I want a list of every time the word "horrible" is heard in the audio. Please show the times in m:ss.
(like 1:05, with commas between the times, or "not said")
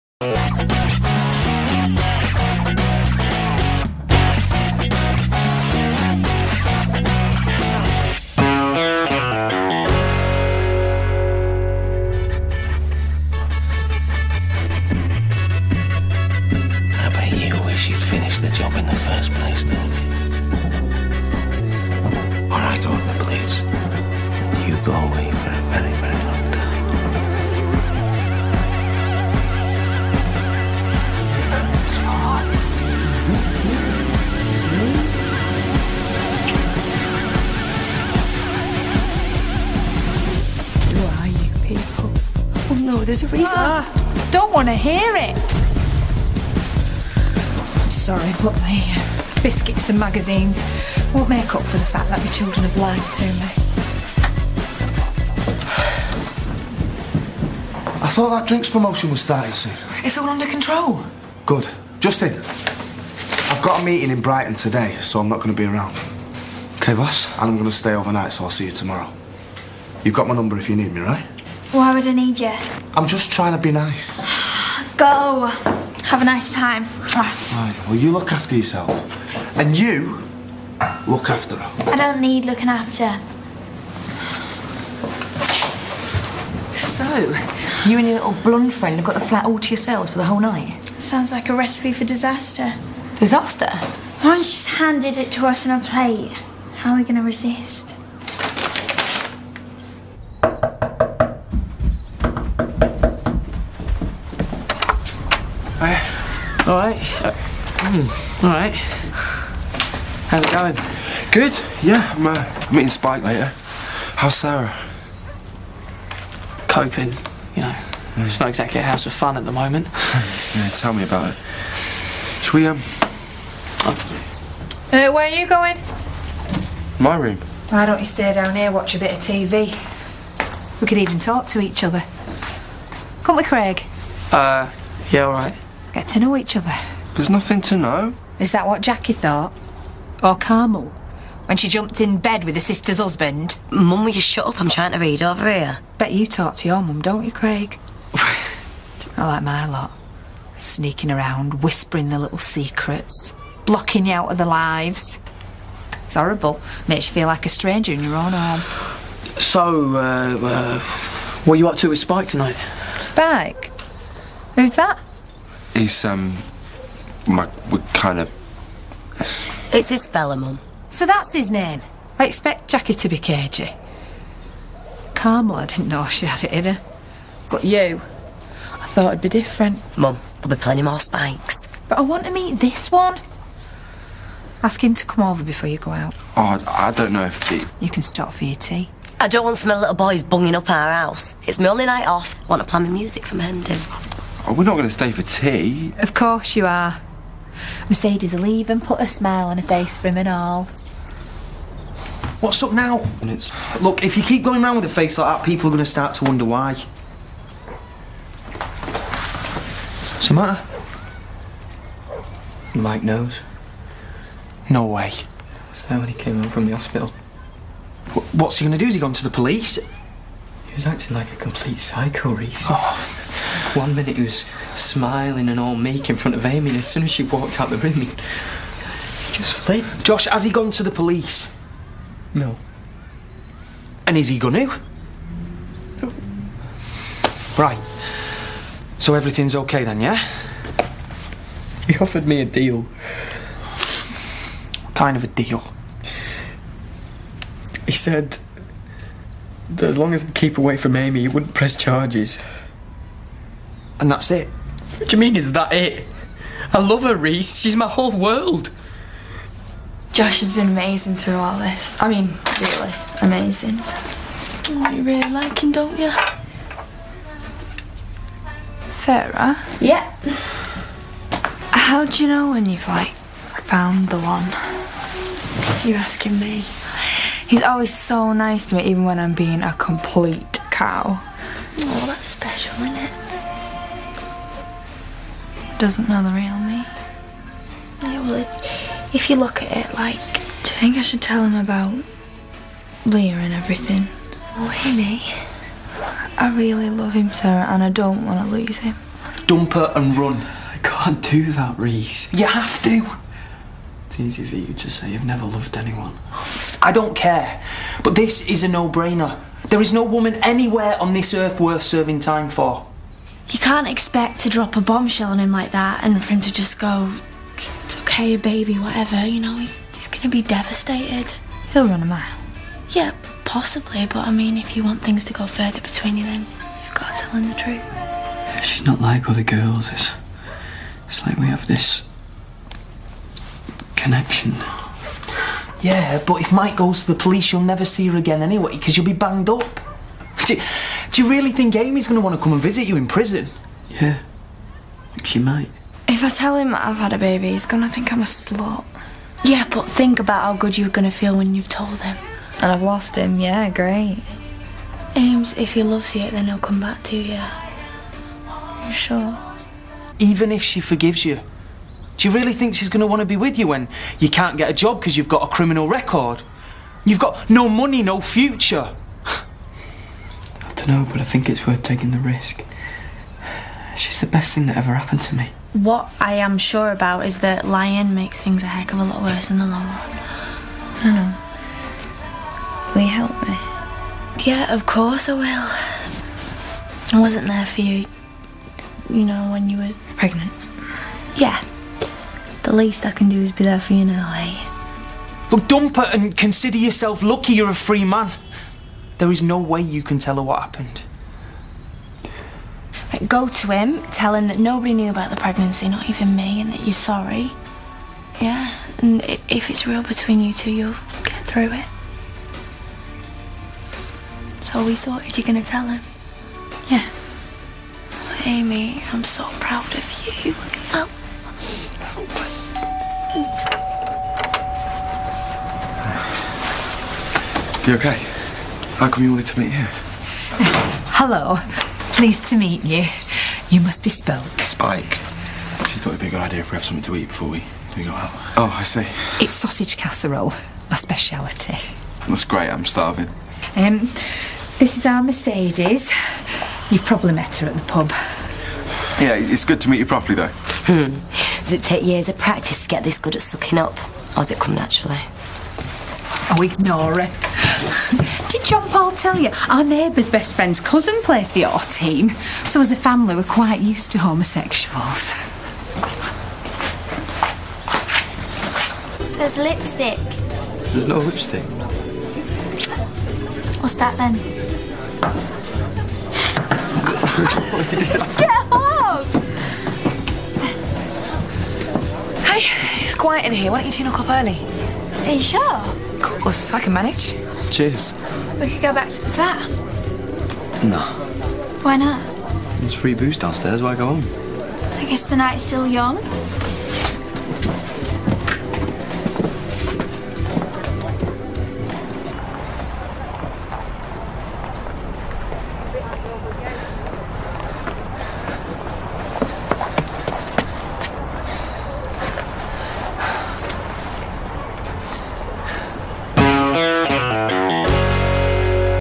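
2:36.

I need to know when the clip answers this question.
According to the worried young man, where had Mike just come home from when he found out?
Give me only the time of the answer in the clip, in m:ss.
3:36.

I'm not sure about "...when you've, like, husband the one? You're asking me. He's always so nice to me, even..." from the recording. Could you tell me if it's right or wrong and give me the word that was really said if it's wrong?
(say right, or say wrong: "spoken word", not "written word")
wrong: "found", not "husband".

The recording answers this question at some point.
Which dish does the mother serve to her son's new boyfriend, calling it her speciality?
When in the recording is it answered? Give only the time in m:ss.
7:19.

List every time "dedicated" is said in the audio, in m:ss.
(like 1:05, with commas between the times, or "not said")
not said.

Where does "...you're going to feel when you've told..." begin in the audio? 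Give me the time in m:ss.
5:50.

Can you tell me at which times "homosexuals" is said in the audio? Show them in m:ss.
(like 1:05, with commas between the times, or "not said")
7:44.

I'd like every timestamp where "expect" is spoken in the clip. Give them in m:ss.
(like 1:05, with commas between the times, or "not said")
2:52, 5:13.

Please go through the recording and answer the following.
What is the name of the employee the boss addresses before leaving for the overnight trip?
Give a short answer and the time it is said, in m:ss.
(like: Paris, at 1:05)
Justin, at 1:02.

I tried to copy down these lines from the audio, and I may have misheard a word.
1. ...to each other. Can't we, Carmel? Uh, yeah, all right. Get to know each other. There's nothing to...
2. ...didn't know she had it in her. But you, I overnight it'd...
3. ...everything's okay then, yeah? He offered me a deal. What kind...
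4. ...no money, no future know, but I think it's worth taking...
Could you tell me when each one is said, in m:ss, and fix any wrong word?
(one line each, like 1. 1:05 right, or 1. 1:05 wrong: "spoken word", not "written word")
1. 2:11 wrong: "Craig", not "Carmel"
2. 2:55 wrong: "thought", not "overnight"
3. 3:59 right
4. 6:07 right.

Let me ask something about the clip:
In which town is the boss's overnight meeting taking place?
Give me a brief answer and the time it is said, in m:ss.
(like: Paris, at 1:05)
Brighton, at 1:04.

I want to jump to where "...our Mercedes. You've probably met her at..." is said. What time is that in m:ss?
7:25.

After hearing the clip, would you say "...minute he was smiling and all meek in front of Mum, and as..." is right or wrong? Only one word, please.
wrong.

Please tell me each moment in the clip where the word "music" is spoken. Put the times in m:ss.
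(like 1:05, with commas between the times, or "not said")
3:12.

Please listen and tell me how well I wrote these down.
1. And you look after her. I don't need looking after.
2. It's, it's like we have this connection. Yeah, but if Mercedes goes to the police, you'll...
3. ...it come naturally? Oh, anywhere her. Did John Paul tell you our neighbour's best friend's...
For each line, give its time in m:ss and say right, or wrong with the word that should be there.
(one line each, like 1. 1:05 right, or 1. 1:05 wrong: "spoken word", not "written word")
1. 1:19 right
2. 5:29 wrong: "Mike", not "Mercedes"
3. 7:34 wrong: "ignore", not "anywhere".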